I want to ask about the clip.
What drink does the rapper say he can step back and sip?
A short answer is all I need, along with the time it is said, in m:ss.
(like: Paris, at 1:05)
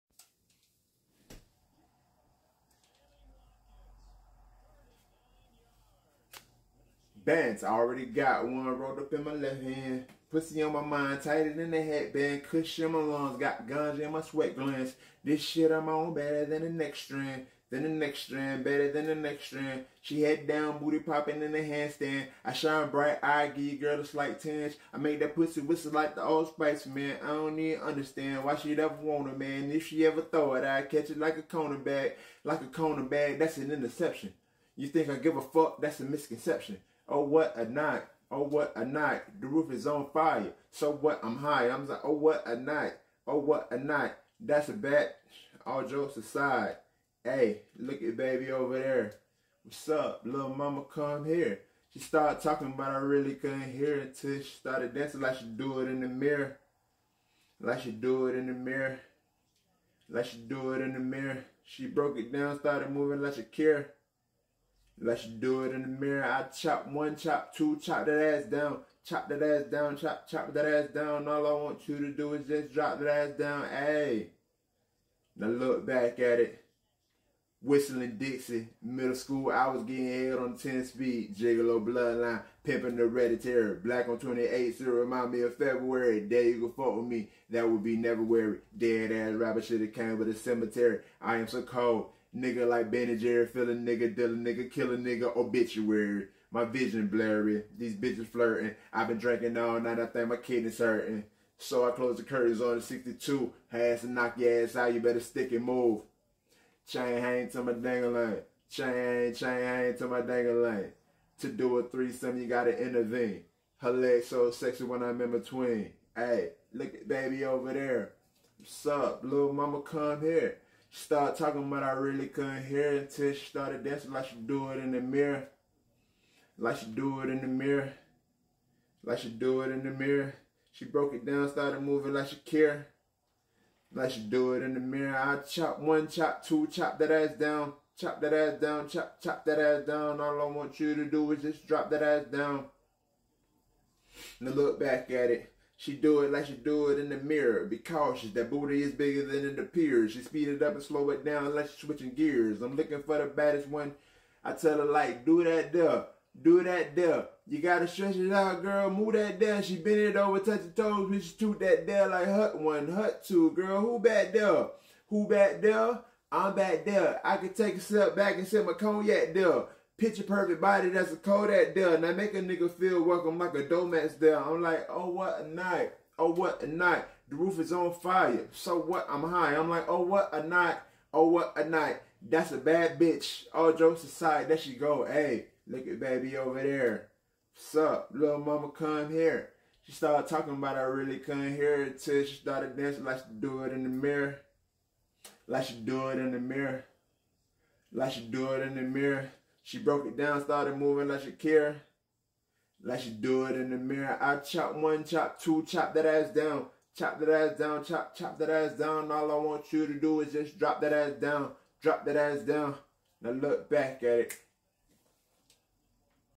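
cognac, at 2:48.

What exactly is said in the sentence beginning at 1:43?
Has to knock your ass out, you better stick and move.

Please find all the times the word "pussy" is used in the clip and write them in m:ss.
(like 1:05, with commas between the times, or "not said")
0:10, 0:25.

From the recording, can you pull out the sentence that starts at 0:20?
She head down, booty popping in the handstand.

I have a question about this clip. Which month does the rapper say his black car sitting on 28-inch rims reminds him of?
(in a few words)
February.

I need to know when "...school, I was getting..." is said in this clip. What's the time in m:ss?
1:19.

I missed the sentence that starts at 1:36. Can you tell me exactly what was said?
My vision blurry, these bitches flirting.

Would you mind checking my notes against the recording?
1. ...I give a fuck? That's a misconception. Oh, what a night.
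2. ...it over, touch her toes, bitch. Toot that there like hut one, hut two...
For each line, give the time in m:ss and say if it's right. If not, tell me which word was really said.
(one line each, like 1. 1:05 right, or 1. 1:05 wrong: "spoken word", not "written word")
1. 0:35 right
2. 2:40 right.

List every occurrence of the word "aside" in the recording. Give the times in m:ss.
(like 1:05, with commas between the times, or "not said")
0:46, 3:04.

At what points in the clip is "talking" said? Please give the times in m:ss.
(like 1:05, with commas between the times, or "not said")
0:52, 2:01, 3:10.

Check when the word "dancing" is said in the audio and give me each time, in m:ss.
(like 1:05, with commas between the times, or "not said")
0:54, 2:03, 3:12.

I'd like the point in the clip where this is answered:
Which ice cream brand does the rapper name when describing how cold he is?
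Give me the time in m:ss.
1:32.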